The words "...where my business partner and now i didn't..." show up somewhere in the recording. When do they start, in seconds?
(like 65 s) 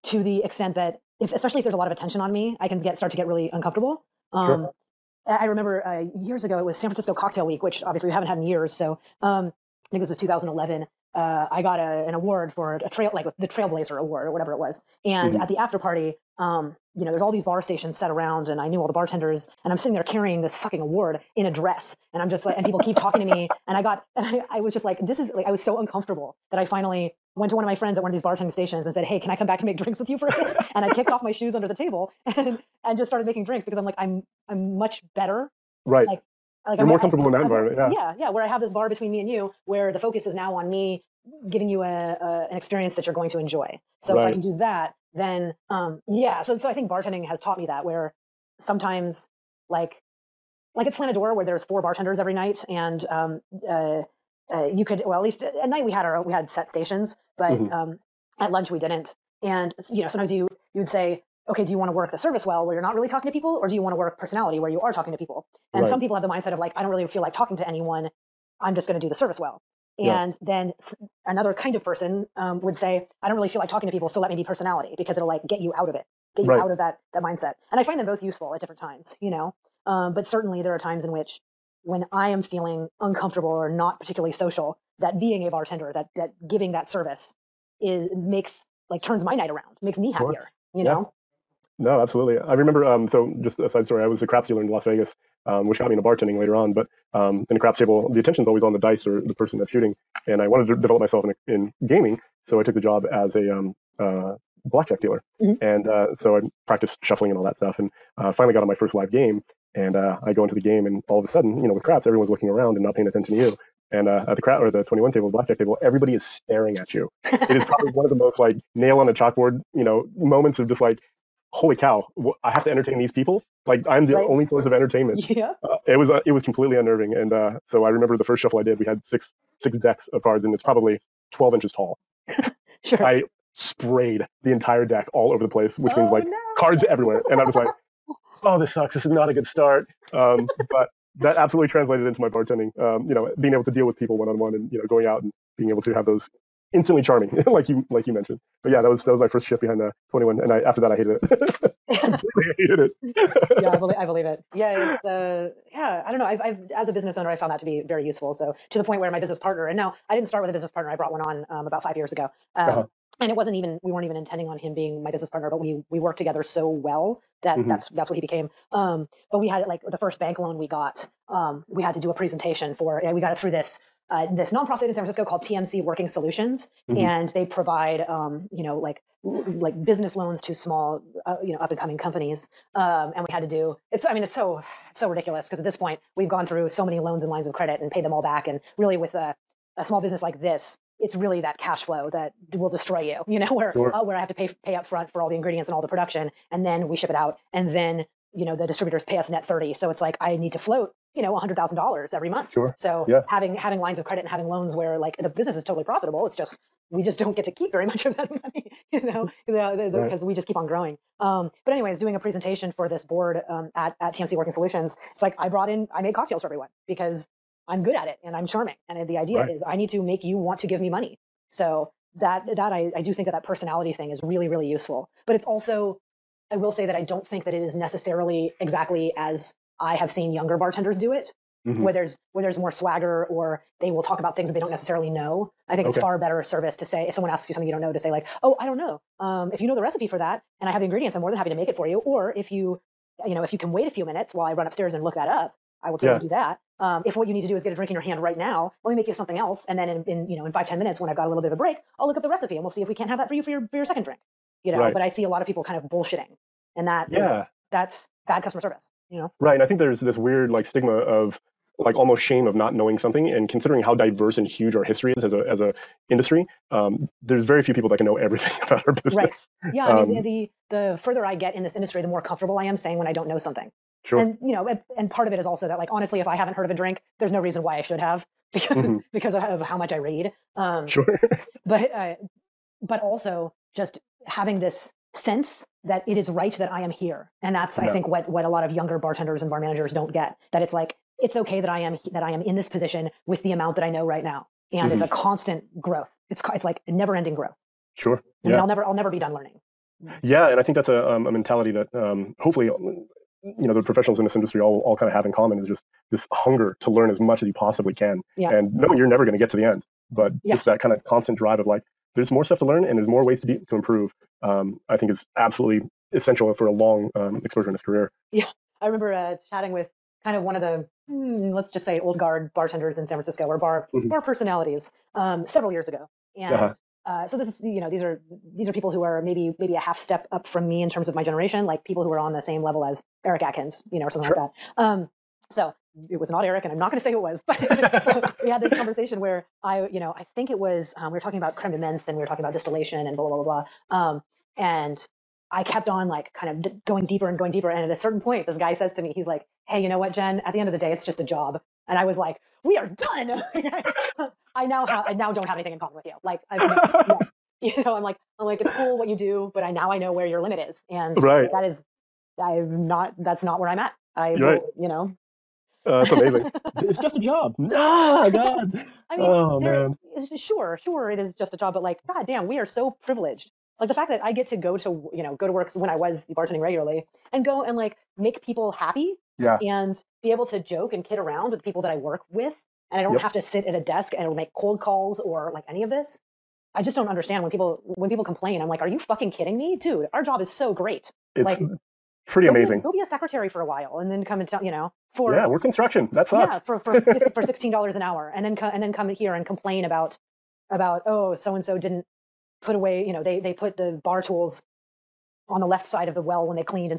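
158 s.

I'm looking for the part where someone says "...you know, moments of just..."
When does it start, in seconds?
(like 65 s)
119 s.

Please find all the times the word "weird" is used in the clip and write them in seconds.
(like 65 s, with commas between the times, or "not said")
260 s.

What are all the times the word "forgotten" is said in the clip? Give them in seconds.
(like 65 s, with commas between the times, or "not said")
not said.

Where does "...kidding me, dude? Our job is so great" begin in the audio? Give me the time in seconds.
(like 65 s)
389 s.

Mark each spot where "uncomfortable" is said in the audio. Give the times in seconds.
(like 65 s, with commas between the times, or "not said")
3 s, 25 s, 83 s.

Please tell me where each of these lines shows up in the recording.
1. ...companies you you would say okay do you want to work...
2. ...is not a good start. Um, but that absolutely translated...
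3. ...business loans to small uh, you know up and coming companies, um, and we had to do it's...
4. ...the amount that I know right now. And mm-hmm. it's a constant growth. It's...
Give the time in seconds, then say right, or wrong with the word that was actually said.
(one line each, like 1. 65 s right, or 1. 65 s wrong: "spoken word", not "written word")
1. 60 s wrong: "sometimes", not "companies"
2. 139 s right
3. 179 s right
4. 293 s right.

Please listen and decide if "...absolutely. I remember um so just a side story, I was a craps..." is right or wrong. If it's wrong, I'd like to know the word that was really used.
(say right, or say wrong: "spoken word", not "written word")
right.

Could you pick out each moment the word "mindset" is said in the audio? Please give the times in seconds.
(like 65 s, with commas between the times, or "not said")
66 s, 77 s.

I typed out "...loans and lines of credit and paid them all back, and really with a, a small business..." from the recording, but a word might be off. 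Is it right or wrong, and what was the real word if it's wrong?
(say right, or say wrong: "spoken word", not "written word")
right.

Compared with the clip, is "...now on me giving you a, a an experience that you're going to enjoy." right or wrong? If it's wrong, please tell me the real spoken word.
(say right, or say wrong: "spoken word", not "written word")
right.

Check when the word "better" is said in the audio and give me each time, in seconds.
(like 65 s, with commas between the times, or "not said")
35 s, 236 s.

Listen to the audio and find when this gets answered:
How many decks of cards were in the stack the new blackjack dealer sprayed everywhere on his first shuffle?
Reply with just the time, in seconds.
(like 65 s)
129 s.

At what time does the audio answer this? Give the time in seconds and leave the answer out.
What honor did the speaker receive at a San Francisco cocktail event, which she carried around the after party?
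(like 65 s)
13 s.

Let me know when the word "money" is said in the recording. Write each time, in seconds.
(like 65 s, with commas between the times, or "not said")
208 s, 220 s.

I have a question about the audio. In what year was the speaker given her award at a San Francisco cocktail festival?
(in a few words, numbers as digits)
2011.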